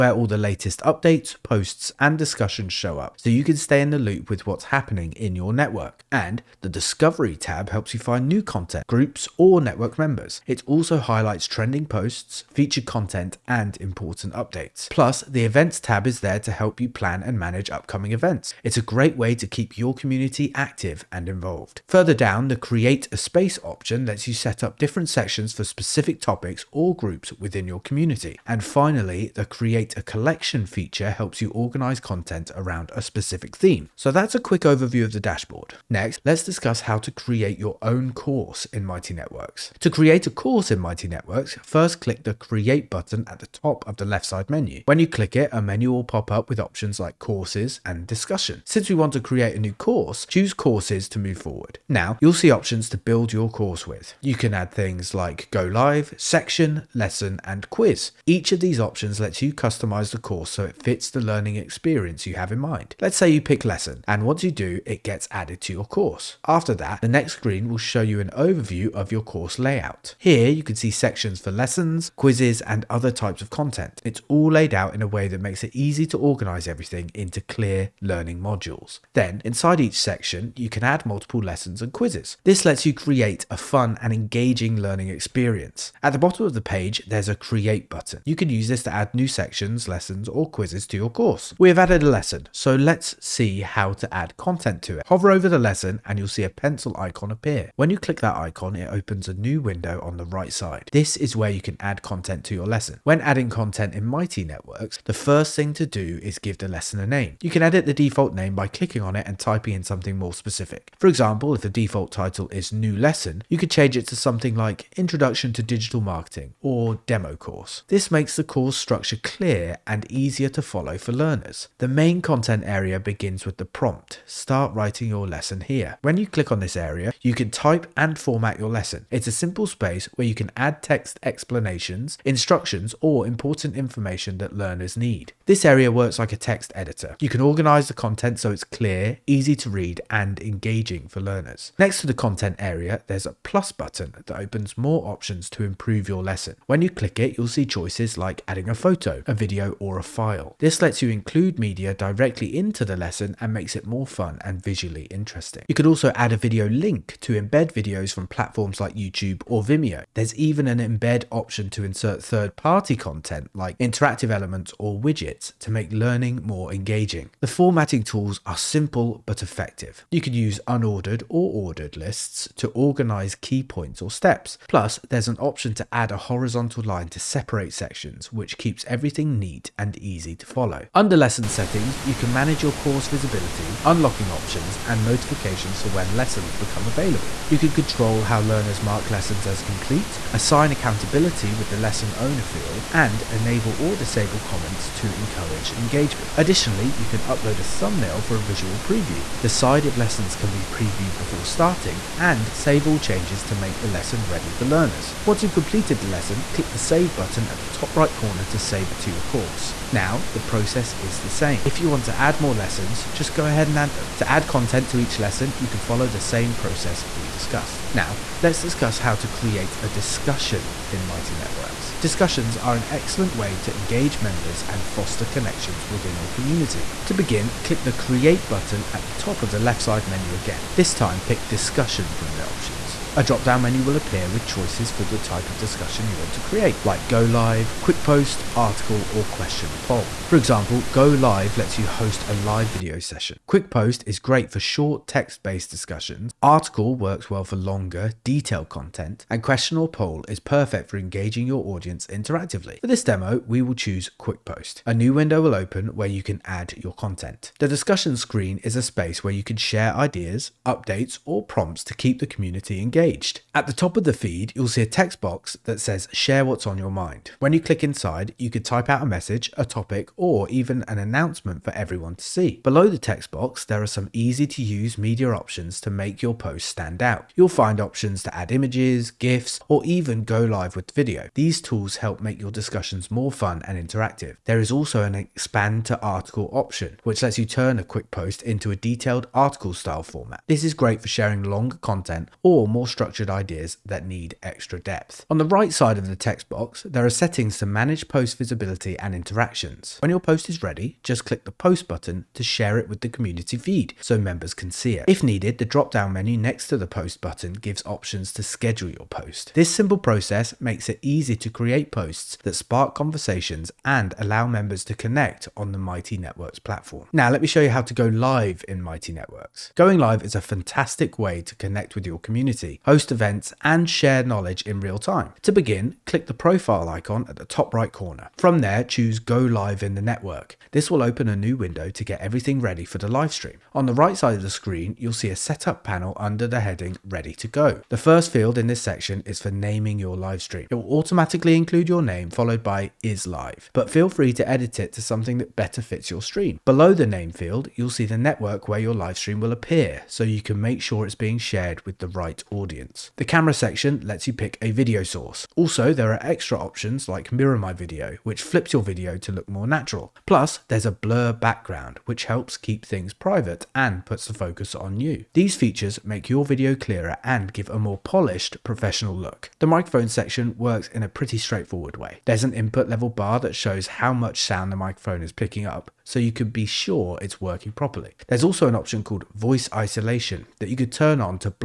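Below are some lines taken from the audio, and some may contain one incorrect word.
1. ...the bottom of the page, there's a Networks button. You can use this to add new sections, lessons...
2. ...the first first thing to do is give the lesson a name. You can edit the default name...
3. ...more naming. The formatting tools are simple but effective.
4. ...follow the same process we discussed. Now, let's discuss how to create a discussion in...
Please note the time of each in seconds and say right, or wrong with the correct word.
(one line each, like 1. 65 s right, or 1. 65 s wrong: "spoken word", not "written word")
1. 86 s wrong: "Create", not "Networks"
2. 105 s right
3. 166 s wrong: "engaging", not "naming"
4. 215 s right.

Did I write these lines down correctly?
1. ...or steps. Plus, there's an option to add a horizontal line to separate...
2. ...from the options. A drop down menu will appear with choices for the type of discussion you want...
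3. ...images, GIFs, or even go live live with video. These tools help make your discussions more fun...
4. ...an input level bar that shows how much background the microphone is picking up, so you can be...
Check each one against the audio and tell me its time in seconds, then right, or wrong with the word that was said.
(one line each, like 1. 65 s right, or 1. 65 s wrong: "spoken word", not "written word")
1. 174 s right
2. 232 s right
3. 278 s right
4. 372 s wrong: "sound", not "background".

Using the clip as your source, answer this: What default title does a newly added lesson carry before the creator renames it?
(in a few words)
New Lesson.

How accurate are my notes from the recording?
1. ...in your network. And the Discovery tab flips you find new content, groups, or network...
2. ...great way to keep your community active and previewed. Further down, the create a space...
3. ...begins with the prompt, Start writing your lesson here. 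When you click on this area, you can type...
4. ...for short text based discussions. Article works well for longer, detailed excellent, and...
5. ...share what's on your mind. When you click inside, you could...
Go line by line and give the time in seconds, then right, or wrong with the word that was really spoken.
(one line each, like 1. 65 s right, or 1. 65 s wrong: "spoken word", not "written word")
1. 5 s wrong: "helps", not "flips"
2. 18 s wrong: "involved", not "previewed"
3. 122 s right
4. 244 s wrong: "content", not "excellent"
5. 266 s right.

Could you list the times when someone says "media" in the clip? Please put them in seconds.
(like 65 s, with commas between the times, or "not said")
151 s, 274 s.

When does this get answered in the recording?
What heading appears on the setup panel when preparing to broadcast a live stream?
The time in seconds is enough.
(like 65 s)
337 s.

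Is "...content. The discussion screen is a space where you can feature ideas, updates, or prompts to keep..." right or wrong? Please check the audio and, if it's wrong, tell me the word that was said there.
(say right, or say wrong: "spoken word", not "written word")
wrong: "share", not "feature".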